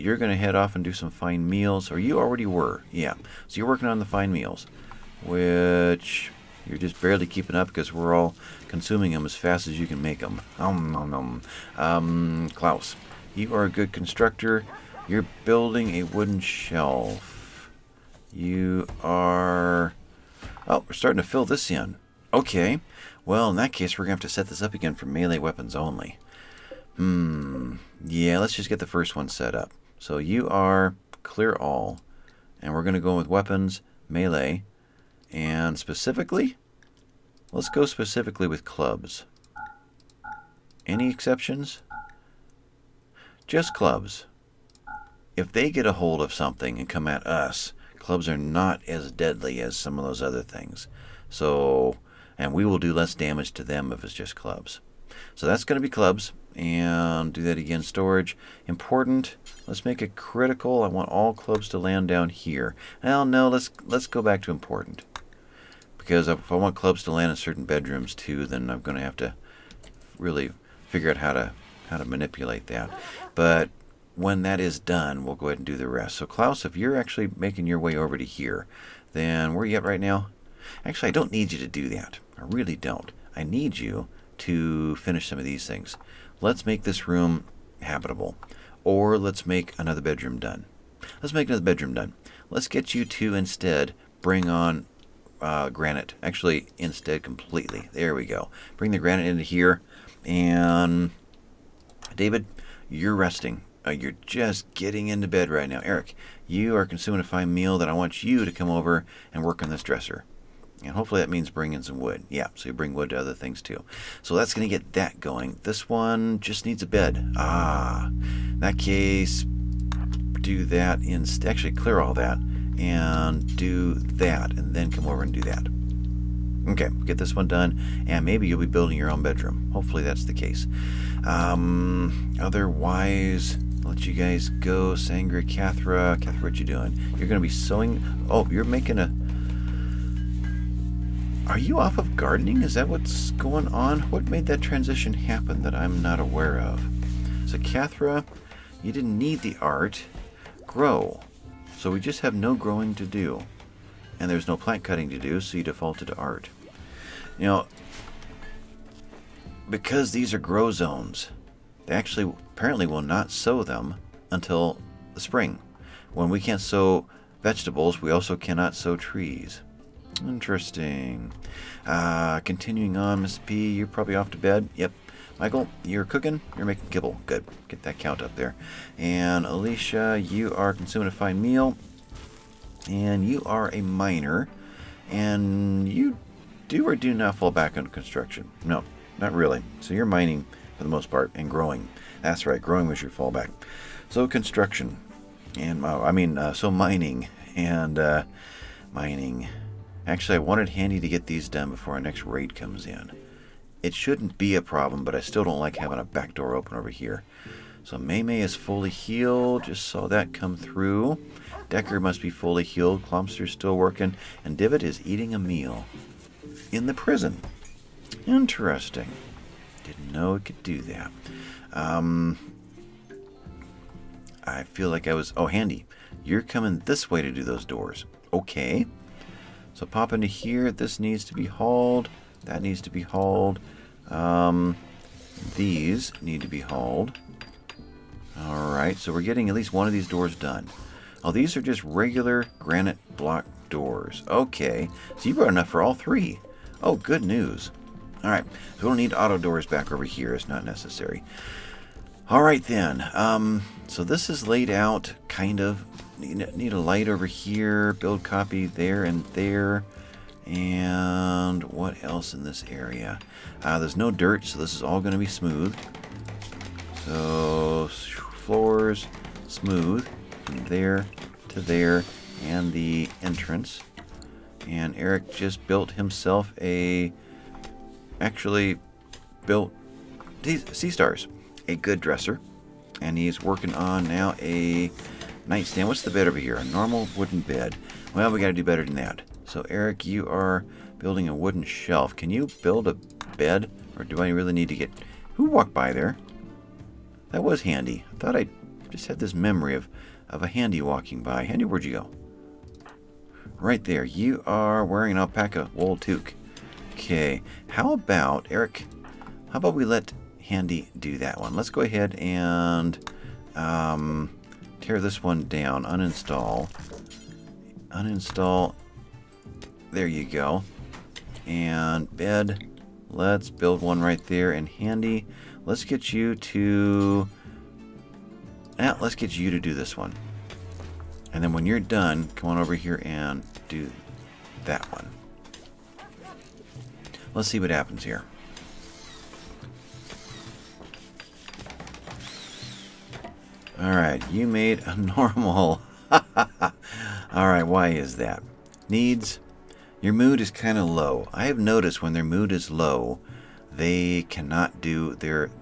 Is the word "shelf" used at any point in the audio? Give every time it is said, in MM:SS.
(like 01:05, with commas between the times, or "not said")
00:16, 04:51.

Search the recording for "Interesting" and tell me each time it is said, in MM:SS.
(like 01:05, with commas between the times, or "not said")
02:50, 03:38.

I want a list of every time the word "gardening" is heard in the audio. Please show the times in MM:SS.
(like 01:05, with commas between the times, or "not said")
02:22.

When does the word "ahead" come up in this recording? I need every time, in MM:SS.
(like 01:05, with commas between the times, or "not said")
01:15, 05:11.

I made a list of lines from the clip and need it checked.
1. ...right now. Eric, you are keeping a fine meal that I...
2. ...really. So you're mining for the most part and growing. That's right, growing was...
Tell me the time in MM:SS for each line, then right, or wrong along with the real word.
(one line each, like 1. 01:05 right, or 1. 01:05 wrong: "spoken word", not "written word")
1. 01:45 wrong: "consuming", not "keeping"
2. 03:09 right.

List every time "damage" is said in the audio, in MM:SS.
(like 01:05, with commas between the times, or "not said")
00:53.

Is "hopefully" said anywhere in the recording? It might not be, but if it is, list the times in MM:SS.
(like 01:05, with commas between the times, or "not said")
01:50, 02:09.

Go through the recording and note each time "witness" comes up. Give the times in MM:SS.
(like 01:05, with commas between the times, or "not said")
not said.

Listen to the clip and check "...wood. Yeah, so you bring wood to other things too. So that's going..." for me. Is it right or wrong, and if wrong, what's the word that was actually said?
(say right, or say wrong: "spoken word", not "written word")
right.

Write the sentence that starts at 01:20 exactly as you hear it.
Actually, I don't need you to do that.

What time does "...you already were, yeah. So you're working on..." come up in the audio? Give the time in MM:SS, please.
00:01.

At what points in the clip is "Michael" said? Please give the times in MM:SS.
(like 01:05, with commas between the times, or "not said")
02:55.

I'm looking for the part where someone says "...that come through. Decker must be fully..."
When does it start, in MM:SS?
03:30.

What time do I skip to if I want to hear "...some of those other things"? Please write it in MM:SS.
00:49.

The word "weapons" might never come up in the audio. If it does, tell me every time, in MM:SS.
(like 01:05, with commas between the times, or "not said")
00:25, 00:33.